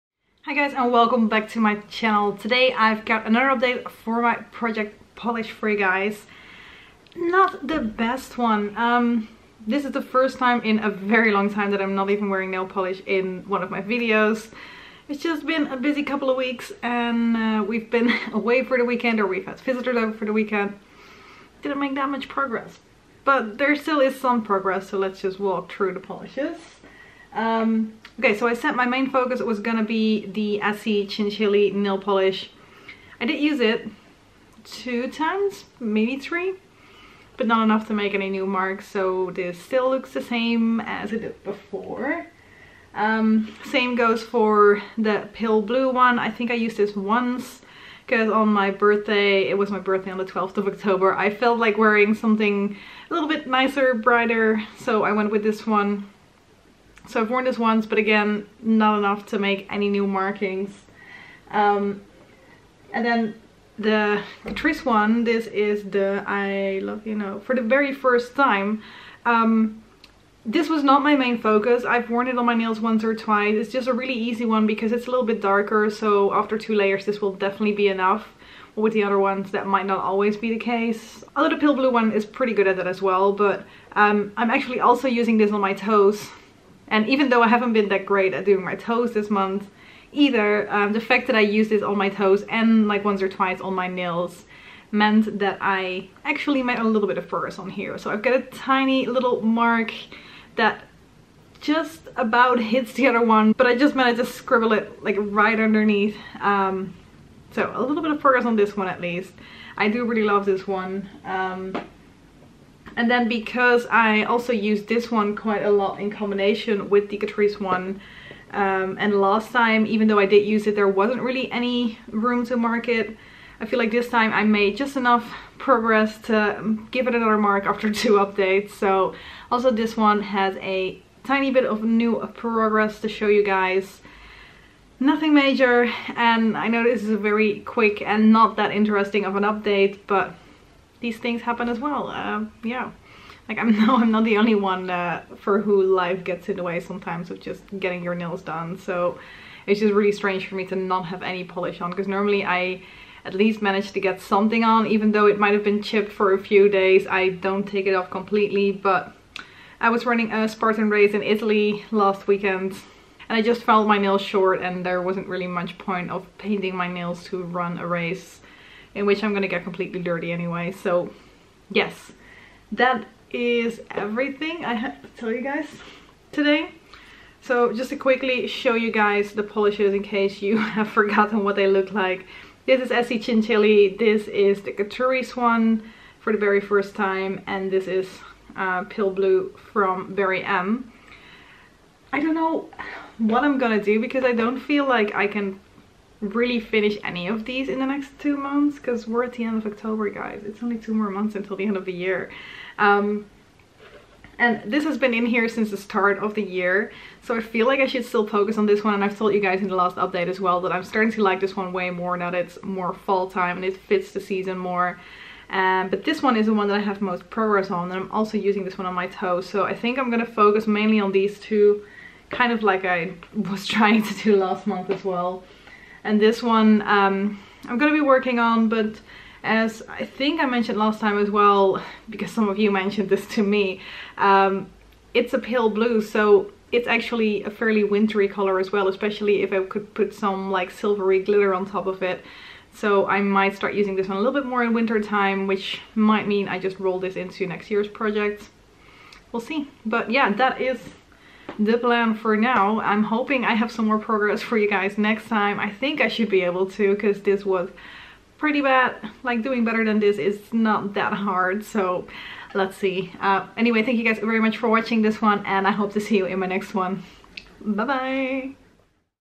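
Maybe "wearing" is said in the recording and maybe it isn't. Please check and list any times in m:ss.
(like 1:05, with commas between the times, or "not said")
0:12, 0:51.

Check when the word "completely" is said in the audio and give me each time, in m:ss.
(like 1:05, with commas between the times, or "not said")
2:38, 2:49.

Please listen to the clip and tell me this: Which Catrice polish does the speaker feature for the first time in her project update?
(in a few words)
I Love You Know.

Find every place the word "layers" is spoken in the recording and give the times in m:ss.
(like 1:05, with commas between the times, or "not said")
1:16.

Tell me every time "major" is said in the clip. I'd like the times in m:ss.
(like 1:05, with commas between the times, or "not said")
2:15.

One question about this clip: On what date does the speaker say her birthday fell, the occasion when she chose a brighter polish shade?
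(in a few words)
12th of October.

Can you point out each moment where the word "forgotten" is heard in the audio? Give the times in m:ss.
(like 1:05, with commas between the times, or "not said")
3:00.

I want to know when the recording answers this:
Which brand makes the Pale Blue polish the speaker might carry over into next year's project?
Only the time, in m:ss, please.
3:10.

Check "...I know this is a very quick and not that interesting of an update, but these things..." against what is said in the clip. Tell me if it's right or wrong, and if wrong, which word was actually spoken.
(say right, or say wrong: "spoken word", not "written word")
right.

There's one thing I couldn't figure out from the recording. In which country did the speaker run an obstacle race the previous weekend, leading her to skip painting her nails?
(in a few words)
Italy.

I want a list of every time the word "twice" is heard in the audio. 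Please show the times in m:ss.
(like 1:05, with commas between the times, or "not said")
1:13, 1:33.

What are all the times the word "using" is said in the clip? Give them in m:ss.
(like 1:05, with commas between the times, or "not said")
1:25, 3:38, 4:03.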